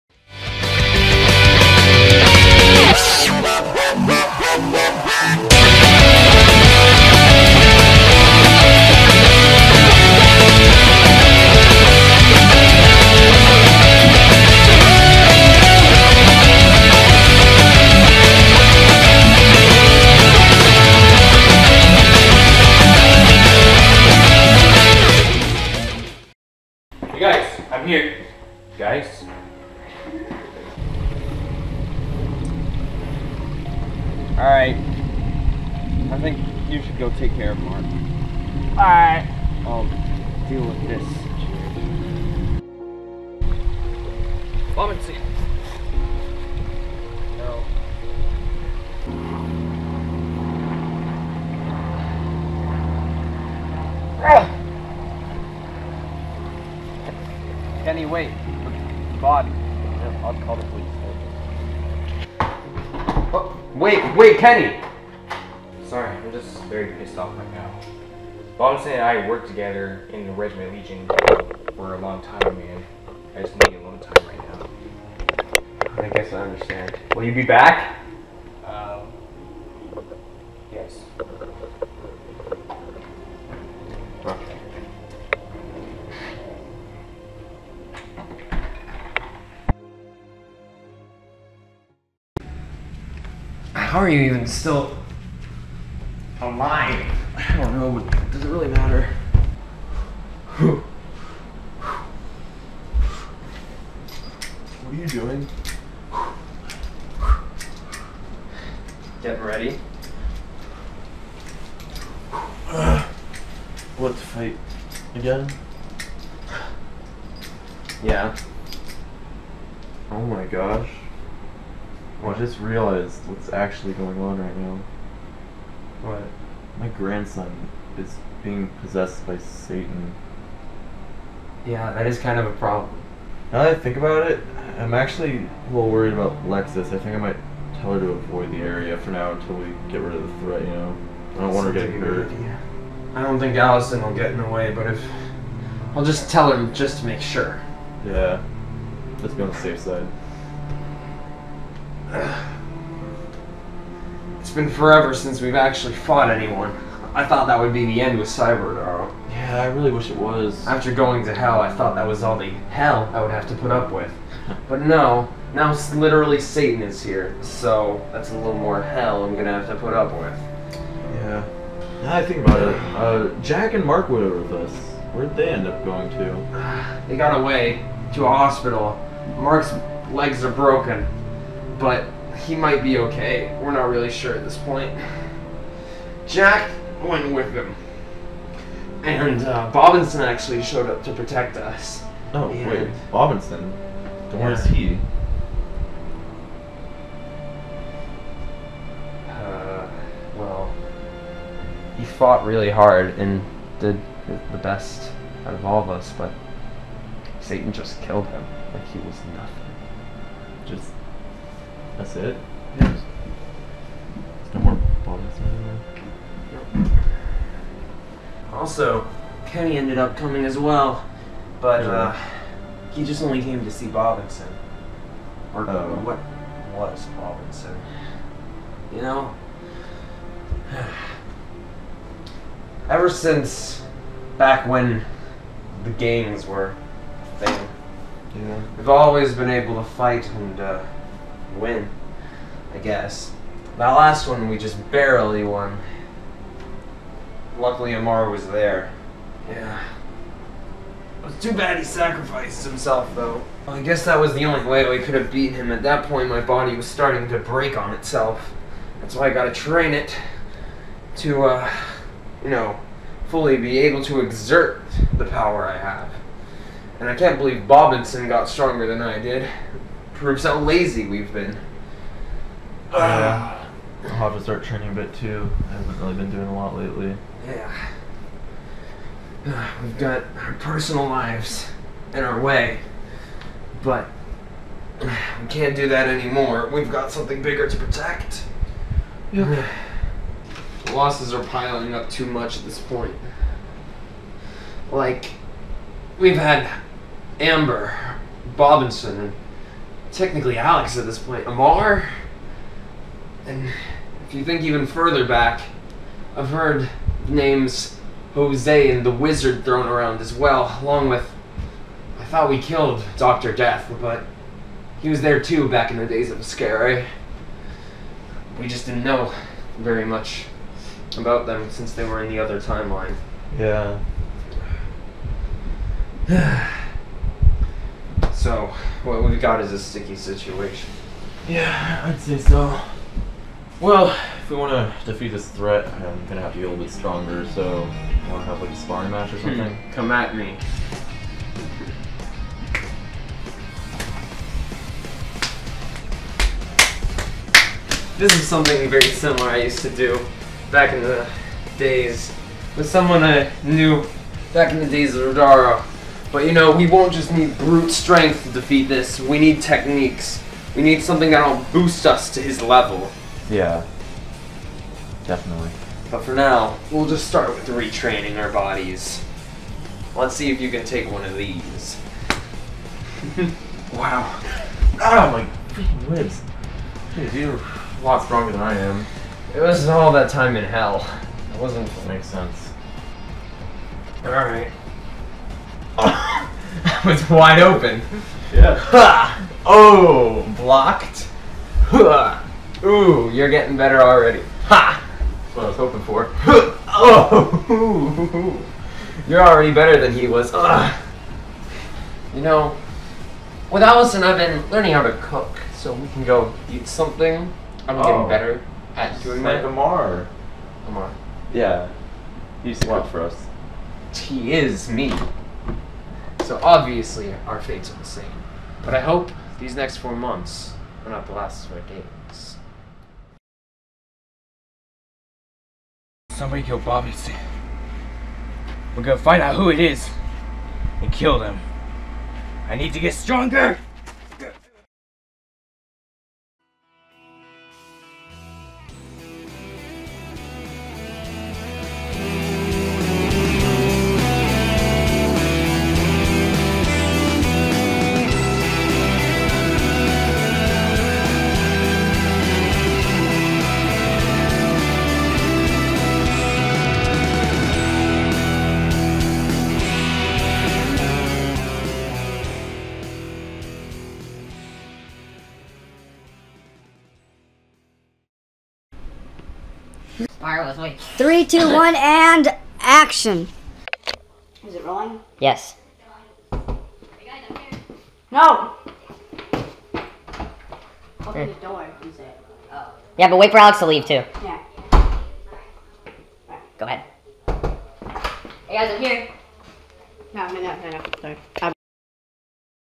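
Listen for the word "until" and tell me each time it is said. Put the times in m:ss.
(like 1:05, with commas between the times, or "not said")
2:19.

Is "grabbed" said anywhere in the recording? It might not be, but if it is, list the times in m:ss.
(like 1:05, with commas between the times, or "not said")
not said.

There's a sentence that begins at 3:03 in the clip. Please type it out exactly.
We're not really sure at this point.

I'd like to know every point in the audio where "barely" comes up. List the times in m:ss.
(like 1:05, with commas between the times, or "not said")
4:04.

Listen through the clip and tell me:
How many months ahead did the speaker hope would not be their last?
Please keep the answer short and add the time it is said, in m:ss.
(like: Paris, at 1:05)
4, at 6:59.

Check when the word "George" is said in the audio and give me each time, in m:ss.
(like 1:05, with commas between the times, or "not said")
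not said.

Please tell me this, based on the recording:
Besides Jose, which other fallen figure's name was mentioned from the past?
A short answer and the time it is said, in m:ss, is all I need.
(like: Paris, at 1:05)
the Wizard, at 5:09.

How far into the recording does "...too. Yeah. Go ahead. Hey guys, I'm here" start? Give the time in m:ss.
8:04.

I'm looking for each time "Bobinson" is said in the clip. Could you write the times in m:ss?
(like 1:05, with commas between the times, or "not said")
4:27, 4:58.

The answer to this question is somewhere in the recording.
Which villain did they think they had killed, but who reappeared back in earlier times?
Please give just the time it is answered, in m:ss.
5:13.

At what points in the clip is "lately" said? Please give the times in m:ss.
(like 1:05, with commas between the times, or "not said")
4:36.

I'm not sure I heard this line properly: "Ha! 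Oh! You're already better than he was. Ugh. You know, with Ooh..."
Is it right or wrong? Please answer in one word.
wrong.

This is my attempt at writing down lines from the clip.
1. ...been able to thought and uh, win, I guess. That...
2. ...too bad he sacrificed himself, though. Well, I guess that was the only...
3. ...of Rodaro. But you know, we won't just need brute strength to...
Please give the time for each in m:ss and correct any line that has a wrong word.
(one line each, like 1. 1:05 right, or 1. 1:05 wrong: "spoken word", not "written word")
1. 3:59 wrong: "fight", not "thought"
2. 4:11 right
3. 5:55 right.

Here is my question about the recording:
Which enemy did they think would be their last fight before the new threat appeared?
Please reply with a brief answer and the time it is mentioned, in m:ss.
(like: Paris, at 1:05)
Cyberdog, at 2:38.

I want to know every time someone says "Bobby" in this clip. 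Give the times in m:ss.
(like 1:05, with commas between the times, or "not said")
7:06.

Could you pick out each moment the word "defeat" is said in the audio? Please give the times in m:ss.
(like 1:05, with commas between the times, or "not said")
5:35, 5:58.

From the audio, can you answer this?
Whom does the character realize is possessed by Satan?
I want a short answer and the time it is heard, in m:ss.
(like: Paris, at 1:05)
My grandson, at 2:06.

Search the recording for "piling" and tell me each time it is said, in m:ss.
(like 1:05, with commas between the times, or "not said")
4:51.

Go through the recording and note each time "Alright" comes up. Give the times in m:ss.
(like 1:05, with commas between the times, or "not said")
0:34, 0:38, 6:24.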